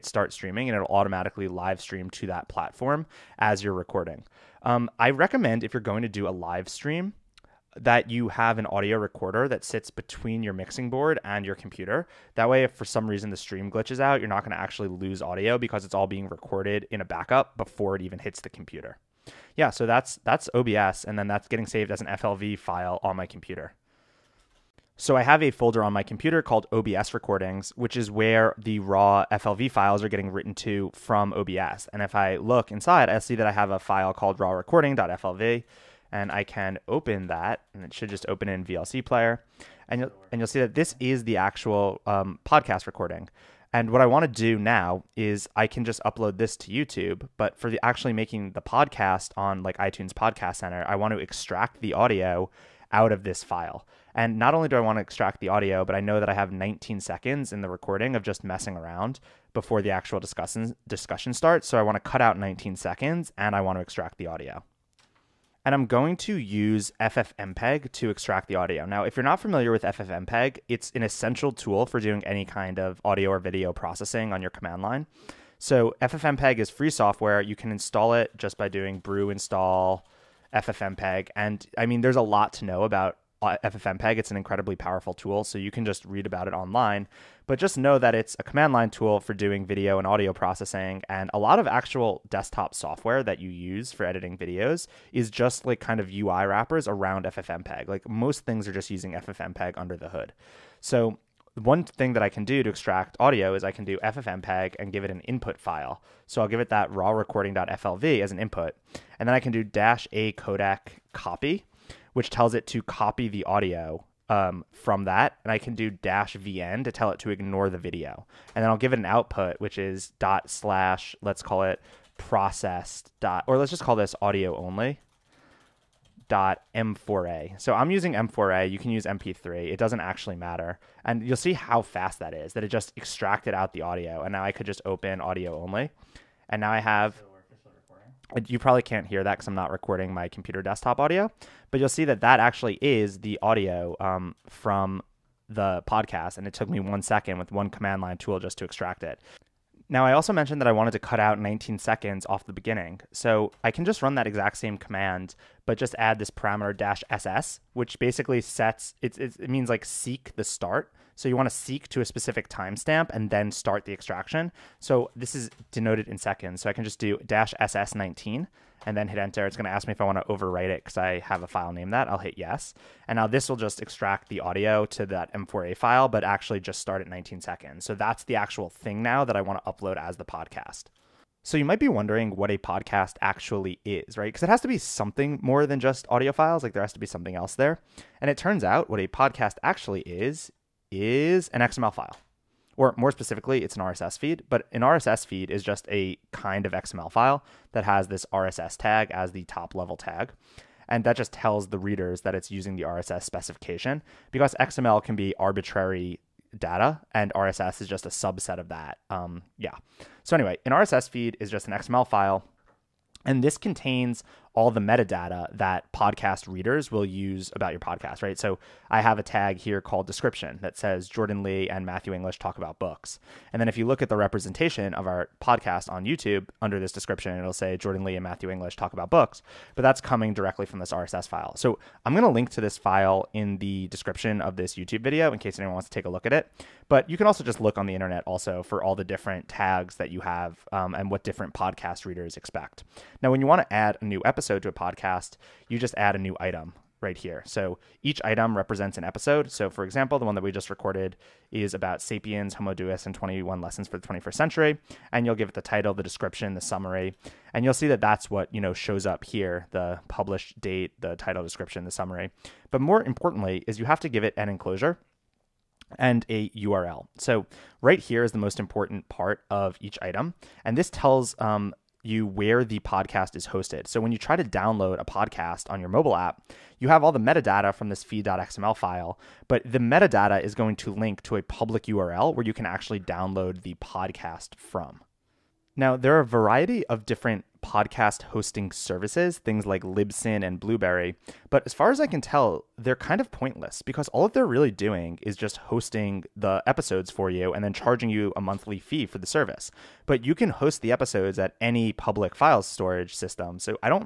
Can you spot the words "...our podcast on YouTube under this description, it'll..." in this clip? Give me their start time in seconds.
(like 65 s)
225 s.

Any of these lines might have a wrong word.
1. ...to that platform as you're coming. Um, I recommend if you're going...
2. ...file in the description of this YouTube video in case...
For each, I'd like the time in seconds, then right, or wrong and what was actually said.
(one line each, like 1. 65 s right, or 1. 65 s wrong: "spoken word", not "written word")
1. 2 s wrong: "recording", not "coming"
2. 232 s right.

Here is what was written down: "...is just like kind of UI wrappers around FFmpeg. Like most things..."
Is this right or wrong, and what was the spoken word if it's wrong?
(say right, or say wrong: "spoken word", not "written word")
right.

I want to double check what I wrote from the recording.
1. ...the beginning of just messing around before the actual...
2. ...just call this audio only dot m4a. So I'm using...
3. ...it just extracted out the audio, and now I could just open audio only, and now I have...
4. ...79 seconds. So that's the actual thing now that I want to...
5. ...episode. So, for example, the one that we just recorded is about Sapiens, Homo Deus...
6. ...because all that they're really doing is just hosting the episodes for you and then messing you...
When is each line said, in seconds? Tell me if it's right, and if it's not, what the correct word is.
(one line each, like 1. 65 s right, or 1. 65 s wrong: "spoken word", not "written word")
1. 57 s wrong: "recording", not "beginning"
2. 123 s right
3. 132 s right
4. 177 s wrong: "19", not "79"
5. 249 s right
6. 293 s wrong: "charging", not "messing".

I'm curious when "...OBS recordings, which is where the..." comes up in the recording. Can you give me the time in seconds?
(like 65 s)
26 s.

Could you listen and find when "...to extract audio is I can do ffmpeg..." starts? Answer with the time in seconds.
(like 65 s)
102 s.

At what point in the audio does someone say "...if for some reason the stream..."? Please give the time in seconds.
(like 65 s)
12 s.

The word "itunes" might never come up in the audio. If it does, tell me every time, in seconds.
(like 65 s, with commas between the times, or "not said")
49 s.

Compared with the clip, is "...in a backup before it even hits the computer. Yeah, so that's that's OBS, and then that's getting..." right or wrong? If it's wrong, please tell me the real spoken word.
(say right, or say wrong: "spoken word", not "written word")
right.